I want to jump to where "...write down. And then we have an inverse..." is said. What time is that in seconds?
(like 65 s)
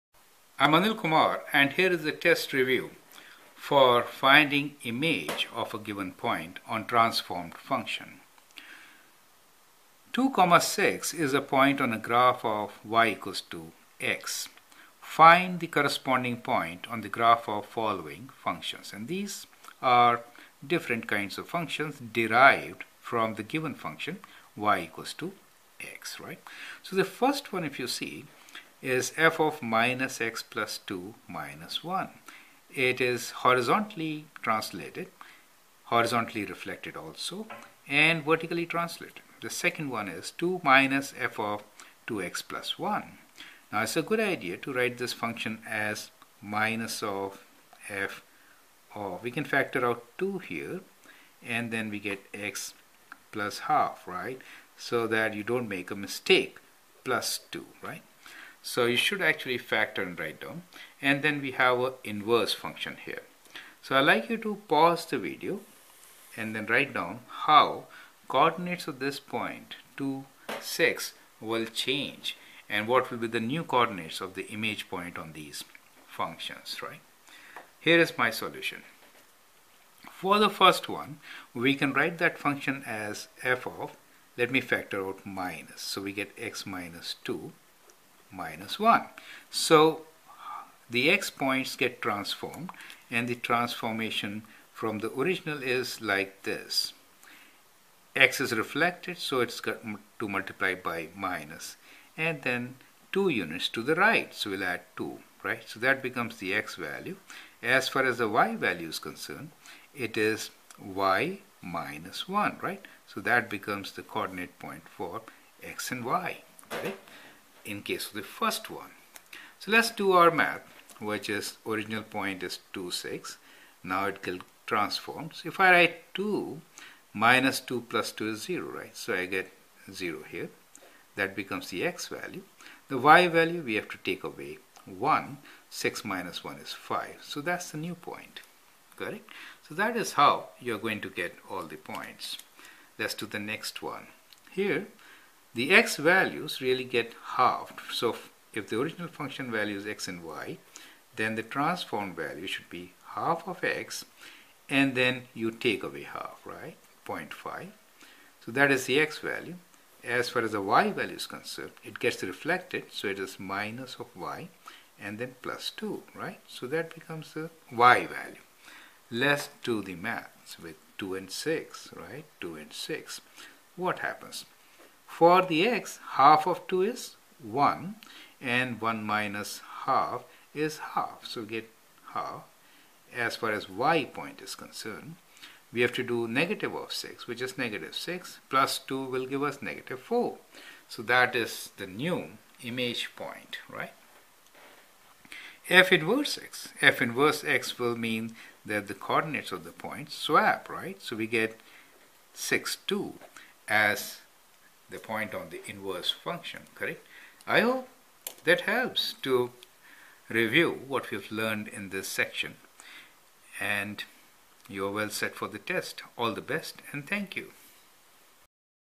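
60 s.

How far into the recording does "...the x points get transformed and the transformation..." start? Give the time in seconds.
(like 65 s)
90 s.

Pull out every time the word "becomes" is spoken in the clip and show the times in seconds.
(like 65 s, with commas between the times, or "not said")
106 s, 113 s, 131 s, 166 s.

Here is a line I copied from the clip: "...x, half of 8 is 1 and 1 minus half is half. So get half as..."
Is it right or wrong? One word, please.
wrong.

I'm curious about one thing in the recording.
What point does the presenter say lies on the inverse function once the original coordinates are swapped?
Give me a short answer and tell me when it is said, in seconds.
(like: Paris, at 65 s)
(6, 2), at 202 s.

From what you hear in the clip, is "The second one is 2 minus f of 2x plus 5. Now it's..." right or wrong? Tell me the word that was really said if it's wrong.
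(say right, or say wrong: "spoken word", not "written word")
wrong: "1", not "5".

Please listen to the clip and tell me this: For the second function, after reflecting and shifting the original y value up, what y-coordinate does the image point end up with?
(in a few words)
-4.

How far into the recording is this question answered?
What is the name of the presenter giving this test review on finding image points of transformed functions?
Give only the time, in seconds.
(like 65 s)
0 s.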